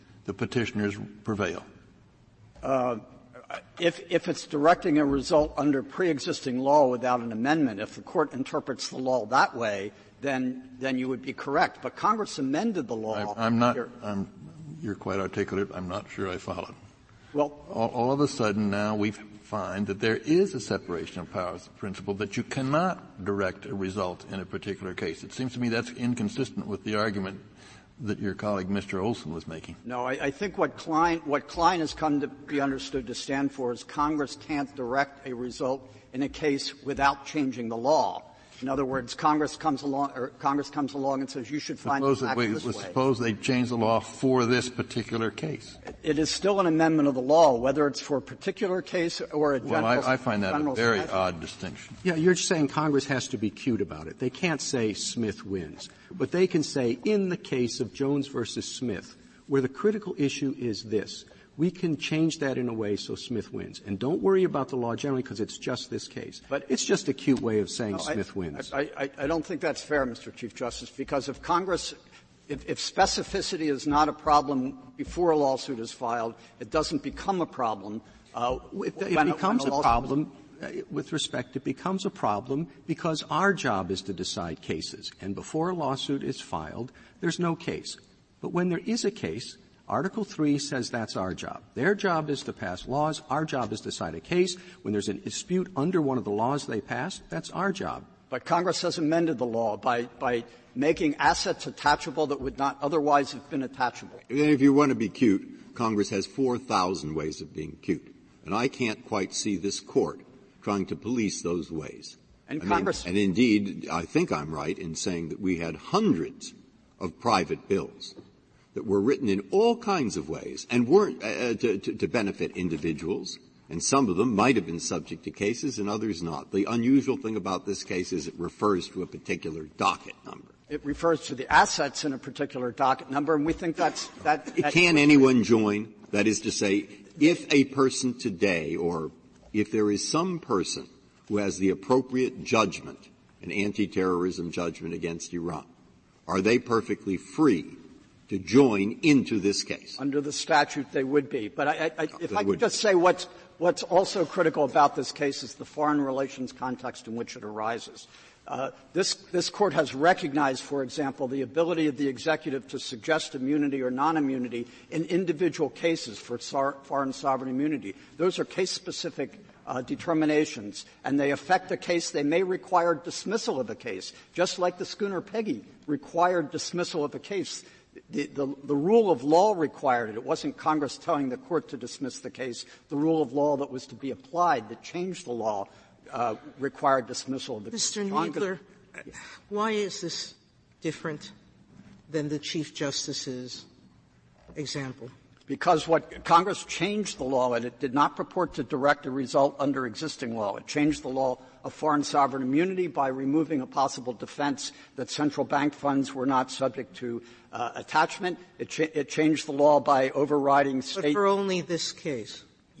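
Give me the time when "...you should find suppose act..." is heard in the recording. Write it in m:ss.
0:41.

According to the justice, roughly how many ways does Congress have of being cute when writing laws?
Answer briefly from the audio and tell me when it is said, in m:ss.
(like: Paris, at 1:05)
4,000, at 1:46.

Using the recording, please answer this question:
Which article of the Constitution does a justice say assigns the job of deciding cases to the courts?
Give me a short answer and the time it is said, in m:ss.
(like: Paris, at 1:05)
Article 3, at 1:29.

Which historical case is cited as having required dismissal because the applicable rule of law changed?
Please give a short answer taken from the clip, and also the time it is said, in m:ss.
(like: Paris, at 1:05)
the Schooner Peggy, at 2:54.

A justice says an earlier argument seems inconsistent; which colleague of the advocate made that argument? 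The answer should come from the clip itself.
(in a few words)
Mr. Olson.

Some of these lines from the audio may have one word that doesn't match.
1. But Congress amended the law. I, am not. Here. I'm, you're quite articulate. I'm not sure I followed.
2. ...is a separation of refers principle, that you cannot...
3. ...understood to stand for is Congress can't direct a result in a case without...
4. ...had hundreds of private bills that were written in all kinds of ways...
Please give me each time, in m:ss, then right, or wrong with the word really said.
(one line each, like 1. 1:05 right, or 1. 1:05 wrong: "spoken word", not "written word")
1. 0:11 right
2. 0:20 wrong: "powers", not "refers"
3. 0:32 right
4. 1:55 right.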